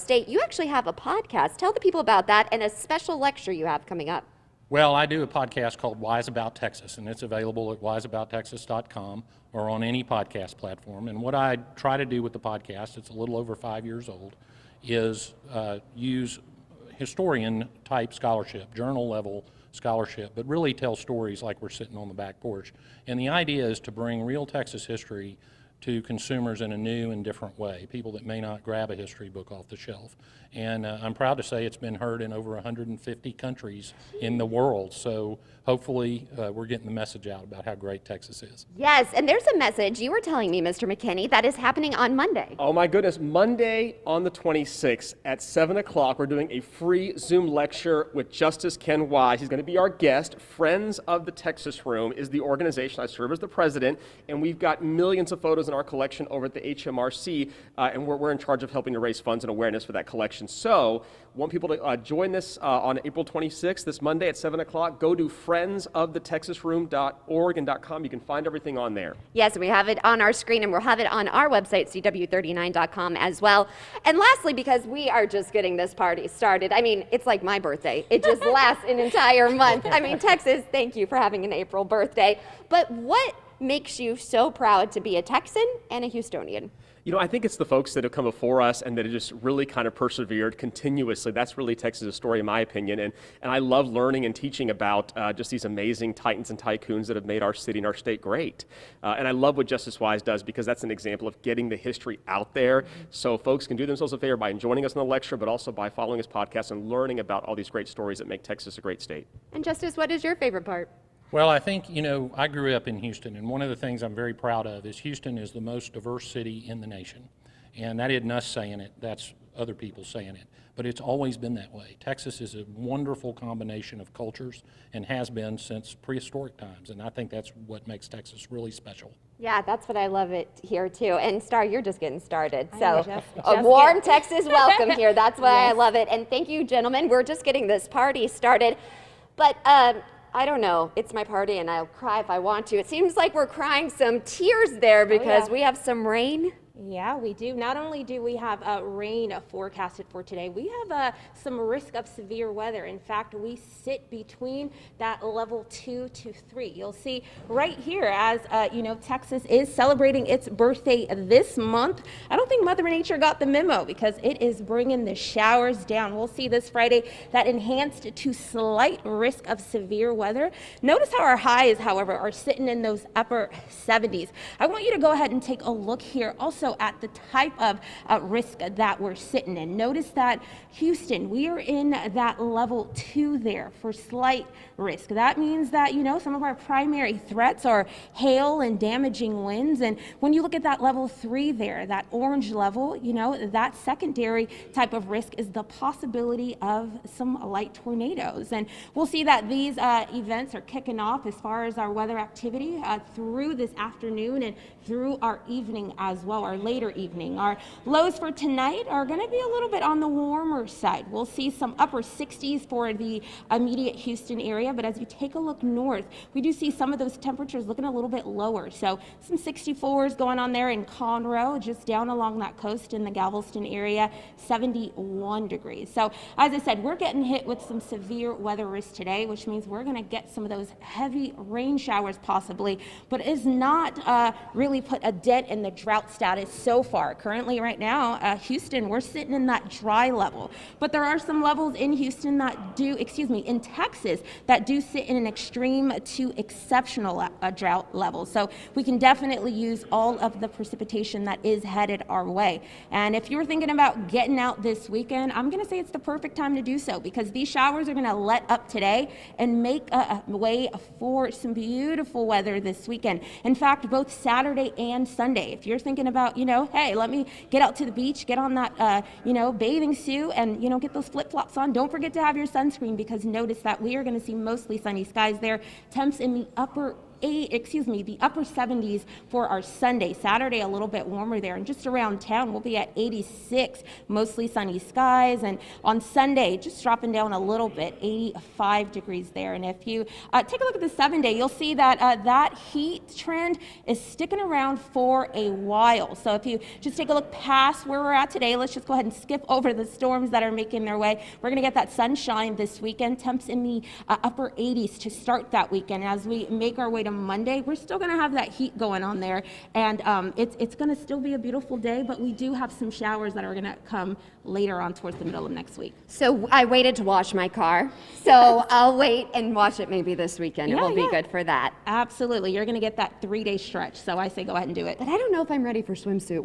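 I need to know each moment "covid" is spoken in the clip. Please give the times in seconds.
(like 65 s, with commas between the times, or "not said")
not said.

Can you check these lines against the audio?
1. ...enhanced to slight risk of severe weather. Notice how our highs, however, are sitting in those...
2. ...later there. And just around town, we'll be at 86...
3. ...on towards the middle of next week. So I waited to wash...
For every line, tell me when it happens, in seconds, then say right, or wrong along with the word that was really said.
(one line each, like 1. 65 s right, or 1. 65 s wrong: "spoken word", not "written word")
1. 167 s right
2. 281 s wrong: "warmer", not "later"
3. 314 s right.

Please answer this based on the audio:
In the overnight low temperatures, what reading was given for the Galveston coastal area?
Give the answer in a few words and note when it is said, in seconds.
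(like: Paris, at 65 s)
71 degrees, at 224 s.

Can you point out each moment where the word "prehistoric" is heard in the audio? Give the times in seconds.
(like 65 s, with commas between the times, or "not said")
125 s.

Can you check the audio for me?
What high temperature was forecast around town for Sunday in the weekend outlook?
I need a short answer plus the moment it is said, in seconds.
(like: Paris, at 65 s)
85 degrees, at 288 s.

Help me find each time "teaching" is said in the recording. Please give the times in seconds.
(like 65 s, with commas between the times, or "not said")
94 s.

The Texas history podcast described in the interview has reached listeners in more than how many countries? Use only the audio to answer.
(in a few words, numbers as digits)
150.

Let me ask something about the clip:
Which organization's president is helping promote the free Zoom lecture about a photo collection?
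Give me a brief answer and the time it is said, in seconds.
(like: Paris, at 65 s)
Friends of the Texas Room, at 50 s.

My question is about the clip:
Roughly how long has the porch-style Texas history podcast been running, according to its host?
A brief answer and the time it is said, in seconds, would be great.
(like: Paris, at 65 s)
a little over 5 years, at 13 s.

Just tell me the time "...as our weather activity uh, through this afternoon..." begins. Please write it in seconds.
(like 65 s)
201 s.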